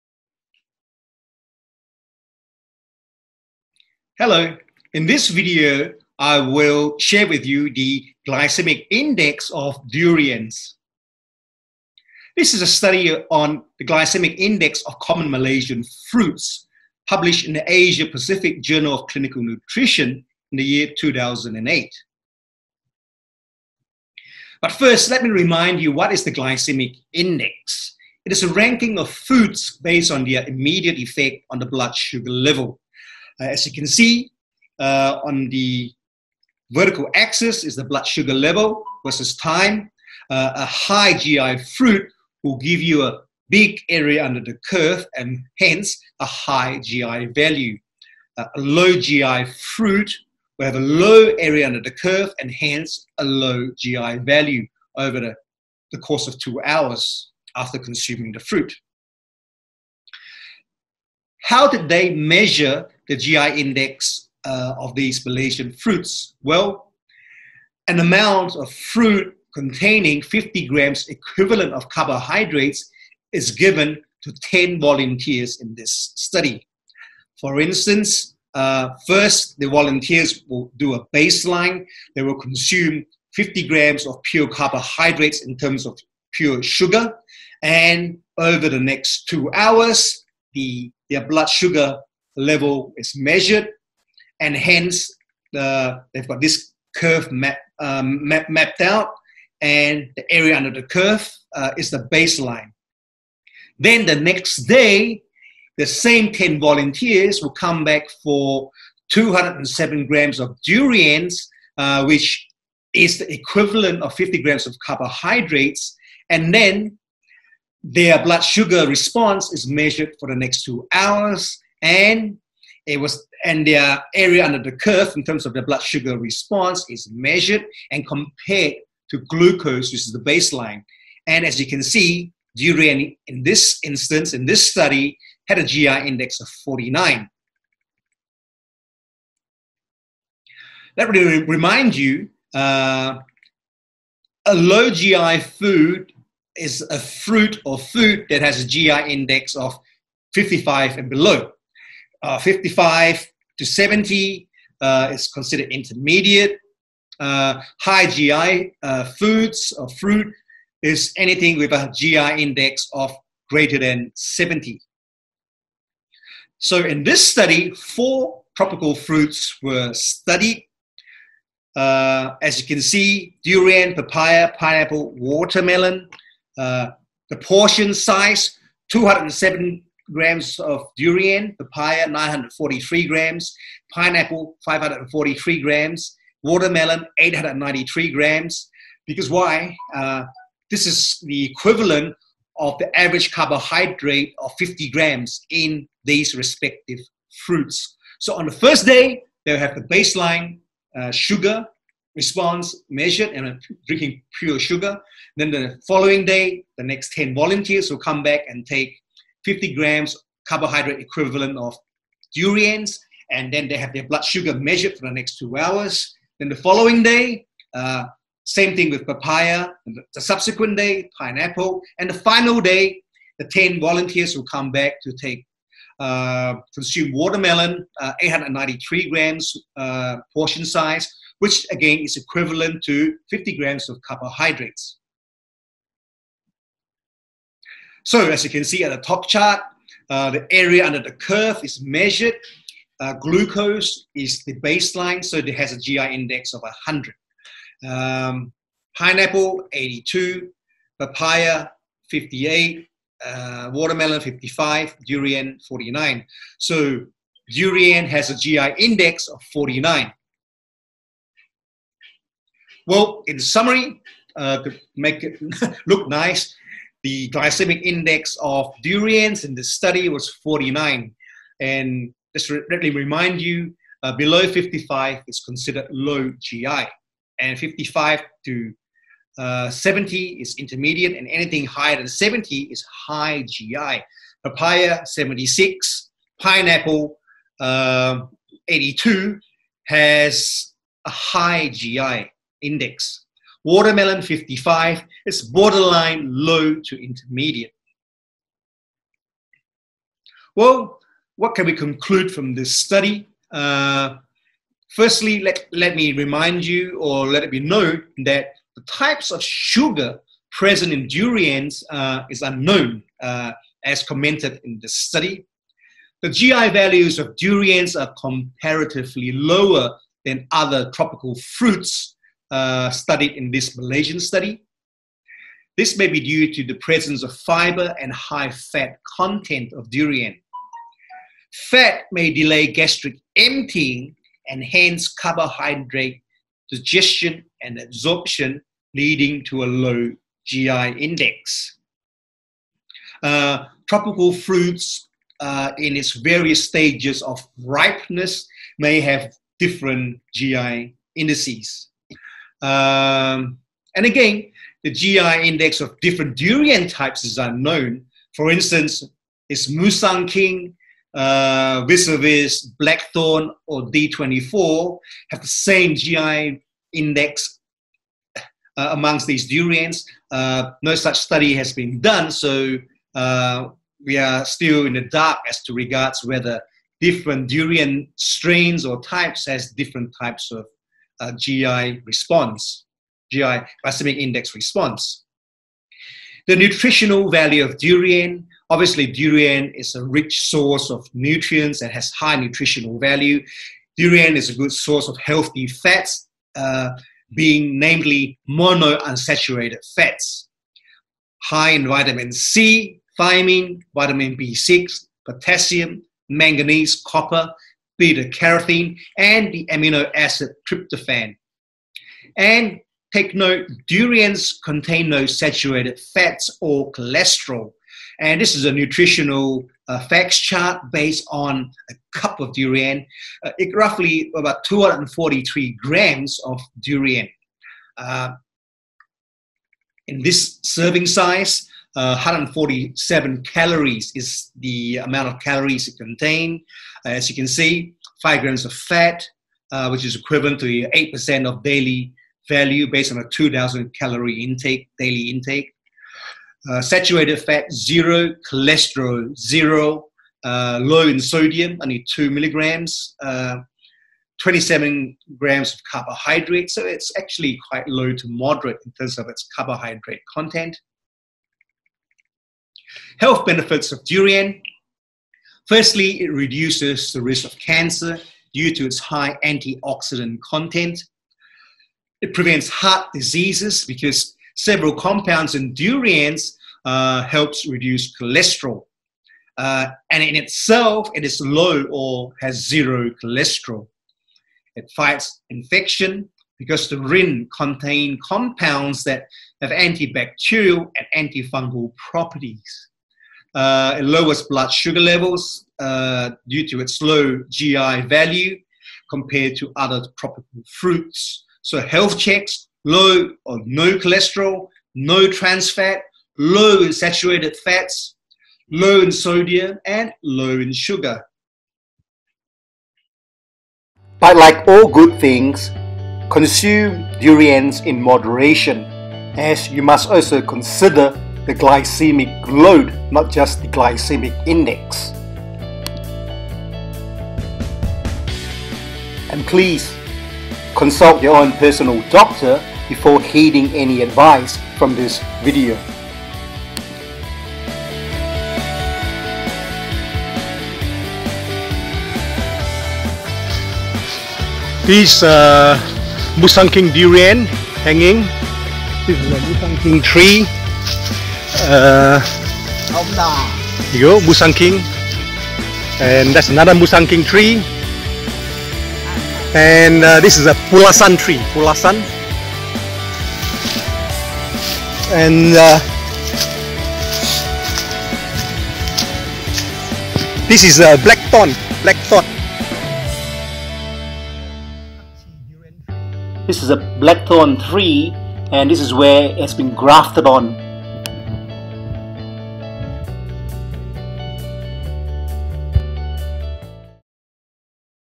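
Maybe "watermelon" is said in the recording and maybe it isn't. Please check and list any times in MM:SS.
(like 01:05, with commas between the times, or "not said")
02:55, 03:06, 03:47, 04:13, 04:53.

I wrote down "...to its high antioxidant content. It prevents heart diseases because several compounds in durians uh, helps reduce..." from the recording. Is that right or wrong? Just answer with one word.
right.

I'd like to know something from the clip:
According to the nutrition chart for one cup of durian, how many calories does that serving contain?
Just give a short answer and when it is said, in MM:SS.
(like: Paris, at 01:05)
147, at 07:12.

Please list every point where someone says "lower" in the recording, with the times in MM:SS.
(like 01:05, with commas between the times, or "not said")
05:19, 08:14.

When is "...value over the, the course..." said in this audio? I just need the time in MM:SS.
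00:54.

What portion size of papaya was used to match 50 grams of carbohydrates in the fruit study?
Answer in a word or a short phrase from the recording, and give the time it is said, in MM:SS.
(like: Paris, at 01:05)
943 grams, at 03:02.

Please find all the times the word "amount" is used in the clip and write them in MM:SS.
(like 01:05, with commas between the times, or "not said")
01:07, 07:14.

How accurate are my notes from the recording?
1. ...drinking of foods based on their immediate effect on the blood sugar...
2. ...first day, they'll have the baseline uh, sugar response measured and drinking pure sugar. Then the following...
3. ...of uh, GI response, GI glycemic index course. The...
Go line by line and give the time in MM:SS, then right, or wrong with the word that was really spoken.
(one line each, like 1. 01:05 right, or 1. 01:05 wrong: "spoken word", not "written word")
1. 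00:28 wrong: "ranking", not "drinking"
2. 03:18 right
3. 06:20 wrong: "response", not "course".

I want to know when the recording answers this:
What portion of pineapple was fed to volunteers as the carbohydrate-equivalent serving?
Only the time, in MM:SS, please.
03:04.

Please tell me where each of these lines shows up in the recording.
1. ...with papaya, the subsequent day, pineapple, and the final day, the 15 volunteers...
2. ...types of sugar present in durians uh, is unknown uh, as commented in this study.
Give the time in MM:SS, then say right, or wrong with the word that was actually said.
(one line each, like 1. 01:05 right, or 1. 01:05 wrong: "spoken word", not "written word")
1. 03:38 wrong: "10", not "15"
2. 05:08 right.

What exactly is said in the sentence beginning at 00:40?
Uh, a high GI fruit will give you a big area under the curve and hence a high GI value.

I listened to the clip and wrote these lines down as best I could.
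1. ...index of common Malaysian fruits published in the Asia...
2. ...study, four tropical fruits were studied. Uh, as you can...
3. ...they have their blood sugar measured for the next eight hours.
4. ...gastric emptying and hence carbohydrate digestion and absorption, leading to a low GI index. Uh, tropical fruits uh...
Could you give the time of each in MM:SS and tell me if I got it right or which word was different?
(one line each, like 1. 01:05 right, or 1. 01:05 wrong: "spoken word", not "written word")
1. 00:14 right
2. 02:47 right
3. 03:33 wrong: "two", not "eight"
4. 05:32 right.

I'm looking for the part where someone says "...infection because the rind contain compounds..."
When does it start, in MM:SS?
08:05.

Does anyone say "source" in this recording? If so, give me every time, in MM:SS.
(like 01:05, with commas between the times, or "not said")
06:30, 06:34.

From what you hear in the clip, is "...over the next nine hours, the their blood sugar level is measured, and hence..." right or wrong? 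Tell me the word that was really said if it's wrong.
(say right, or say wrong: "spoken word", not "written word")
wrong: "two", not "nine".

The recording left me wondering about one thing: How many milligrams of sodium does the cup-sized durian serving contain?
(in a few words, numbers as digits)
2 milligrams.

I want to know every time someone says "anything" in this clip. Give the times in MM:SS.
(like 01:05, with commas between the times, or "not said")
02:41, 04:41.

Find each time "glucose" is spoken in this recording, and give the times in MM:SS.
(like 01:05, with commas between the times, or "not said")
02:09, 04:03.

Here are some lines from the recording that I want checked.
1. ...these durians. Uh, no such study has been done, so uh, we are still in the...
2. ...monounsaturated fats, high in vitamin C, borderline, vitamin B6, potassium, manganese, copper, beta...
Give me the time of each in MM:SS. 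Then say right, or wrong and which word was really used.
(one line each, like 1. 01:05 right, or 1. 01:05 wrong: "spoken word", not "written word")
1. 06:09 right
2. 06:38 wrong: "thiamine", not "borderline".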